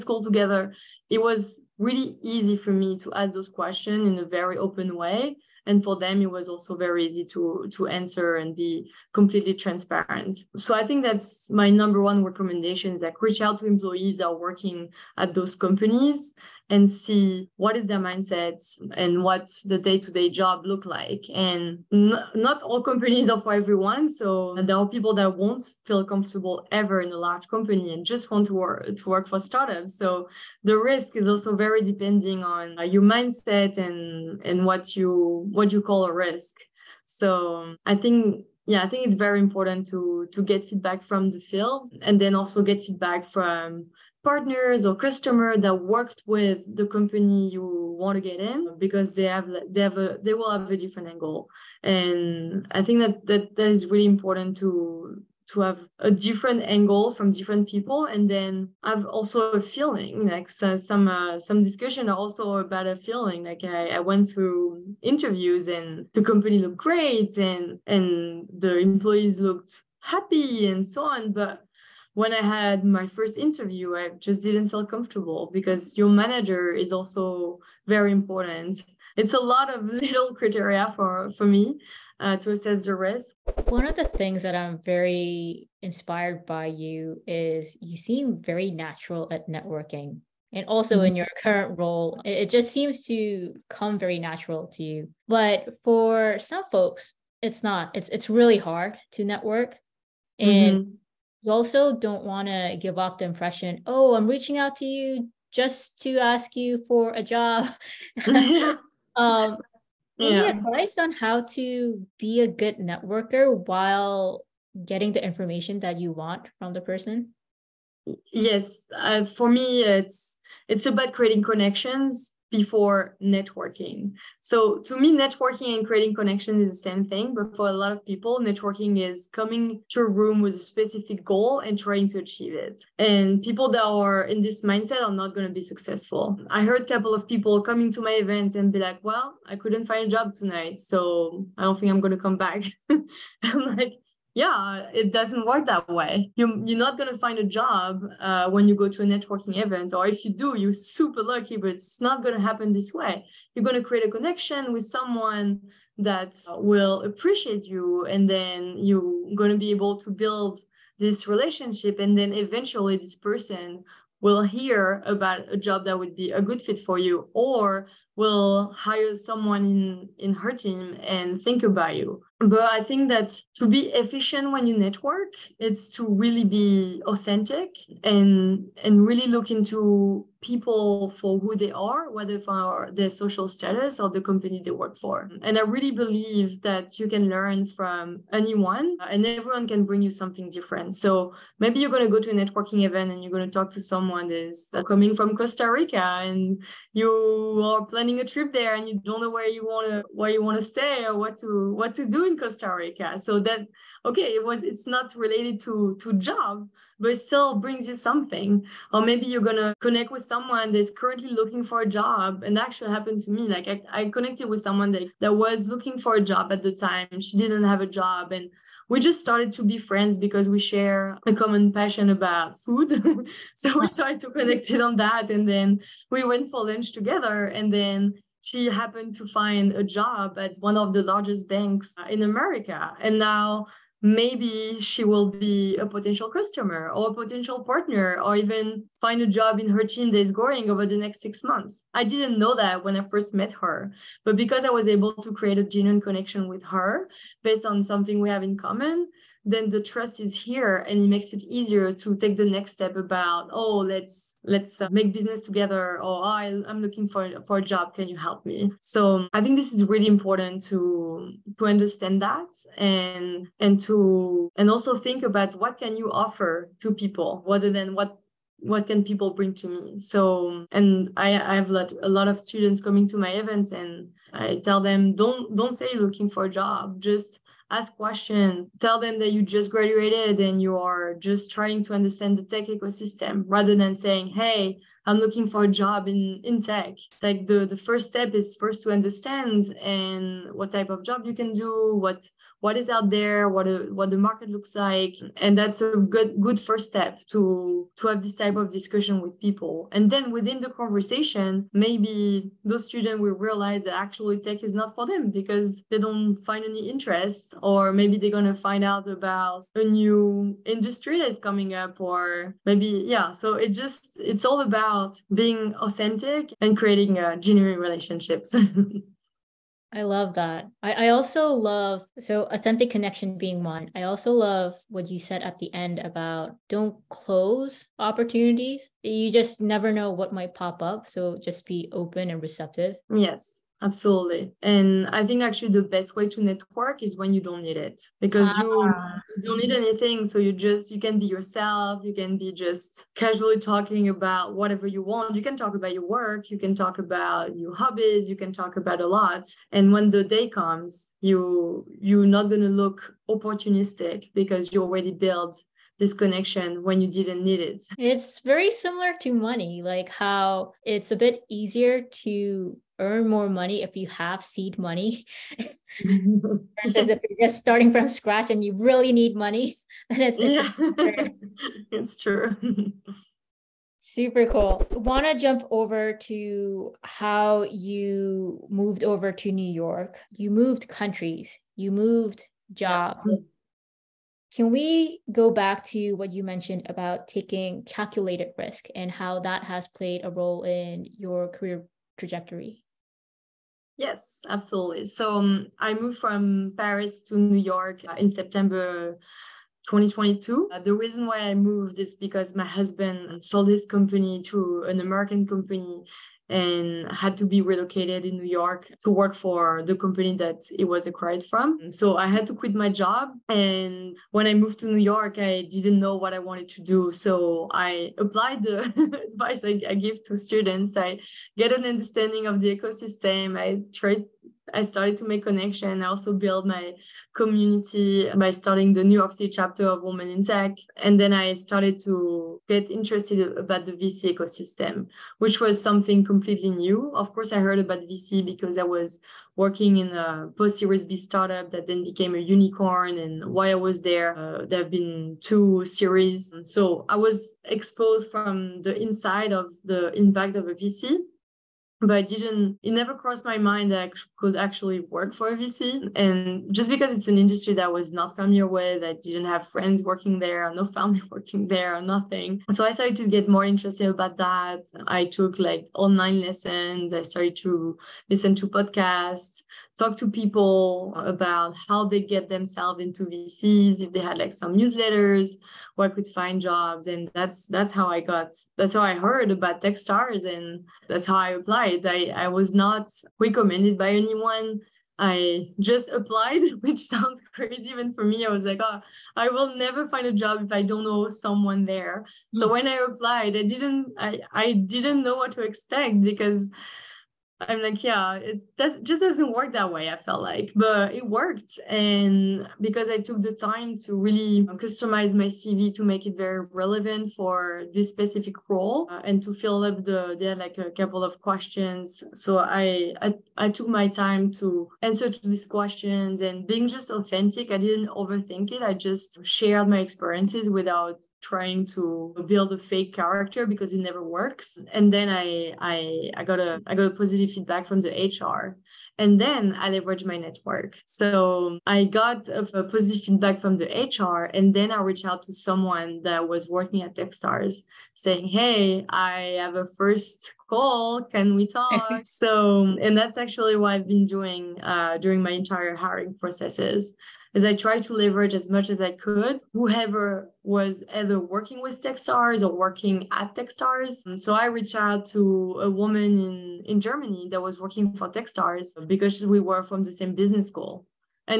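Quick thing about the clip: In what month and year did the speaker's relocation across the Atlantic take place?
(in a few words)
September 2022.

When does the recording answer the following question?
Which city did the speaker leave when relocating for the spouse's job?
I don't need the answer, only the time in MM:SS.
06:36.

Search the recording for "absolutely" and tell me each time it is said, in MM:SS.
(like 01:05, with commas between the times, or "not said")
05:33, 06:34.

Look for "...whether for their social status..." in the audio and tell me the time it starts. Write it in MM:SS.
03:02.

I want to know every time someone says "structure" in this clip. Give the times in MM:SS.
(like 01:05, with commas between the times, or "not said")
not said.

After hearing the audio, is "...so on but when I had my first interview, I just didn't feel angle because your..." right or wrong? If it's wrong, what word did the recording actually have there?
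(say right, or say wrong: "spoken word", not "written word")
wrong: "comfortable", not "angle".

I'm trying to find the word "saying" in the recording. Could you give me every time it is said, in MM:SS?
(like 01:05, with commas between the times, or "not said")
04:43, 08:58.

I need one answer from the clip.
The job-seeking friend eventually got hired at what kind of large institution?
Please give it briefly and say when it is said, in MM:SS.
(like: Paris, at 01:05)
One of the largest banks in America, at 03:51.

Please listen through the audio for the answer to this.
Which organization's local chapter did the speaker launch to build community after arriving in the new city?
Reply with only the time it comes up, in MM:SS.
07:10.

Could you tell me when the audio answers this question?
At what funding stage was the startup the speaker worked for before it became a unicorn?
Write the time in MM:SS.
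07:20.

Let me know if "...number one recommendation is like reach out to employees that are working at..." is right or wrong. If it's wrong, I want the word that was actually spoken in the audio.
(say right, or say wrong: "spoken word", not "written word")
right.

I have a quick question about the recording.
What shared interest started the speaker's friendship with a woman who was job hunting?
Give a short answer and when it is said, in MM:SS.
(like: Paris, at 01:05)
Food, at 03:42.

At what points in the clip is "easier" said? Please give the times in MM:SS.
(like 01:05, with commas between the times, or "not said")
04:11, 06:01.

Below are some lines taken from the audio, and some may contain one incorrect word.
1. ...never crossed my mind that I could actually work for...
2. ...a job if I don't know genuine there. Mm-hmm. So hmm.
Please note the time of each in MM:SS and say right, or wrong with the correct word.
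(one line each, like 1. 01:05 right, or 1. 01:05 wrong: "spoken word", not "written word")
1. 07:32 right
2. 08:10 wrong: "someone", not "genuine".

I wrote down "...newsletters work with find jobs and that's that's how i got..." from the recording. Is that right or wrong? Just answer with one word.
right.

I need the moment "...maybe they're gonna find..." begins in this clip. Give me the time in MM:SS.
05:07.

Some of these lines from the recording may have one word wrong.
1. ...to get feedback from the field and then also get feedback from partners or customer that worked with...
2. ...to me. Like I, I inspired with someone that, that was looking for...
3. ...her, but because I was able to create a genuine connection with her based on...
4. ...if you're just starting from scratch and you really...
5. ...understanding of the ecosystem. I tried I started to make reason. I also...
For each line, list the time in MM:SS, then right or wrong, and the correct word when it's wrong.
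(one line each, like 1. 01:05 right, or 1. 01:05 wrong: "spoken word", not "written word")
1. 00:40 right
2. 03:33 wrong: "connected", not "inspired"
3. 04:03 right
4. 06:07 right
5. 07:01 wrong: "connection", not "reason".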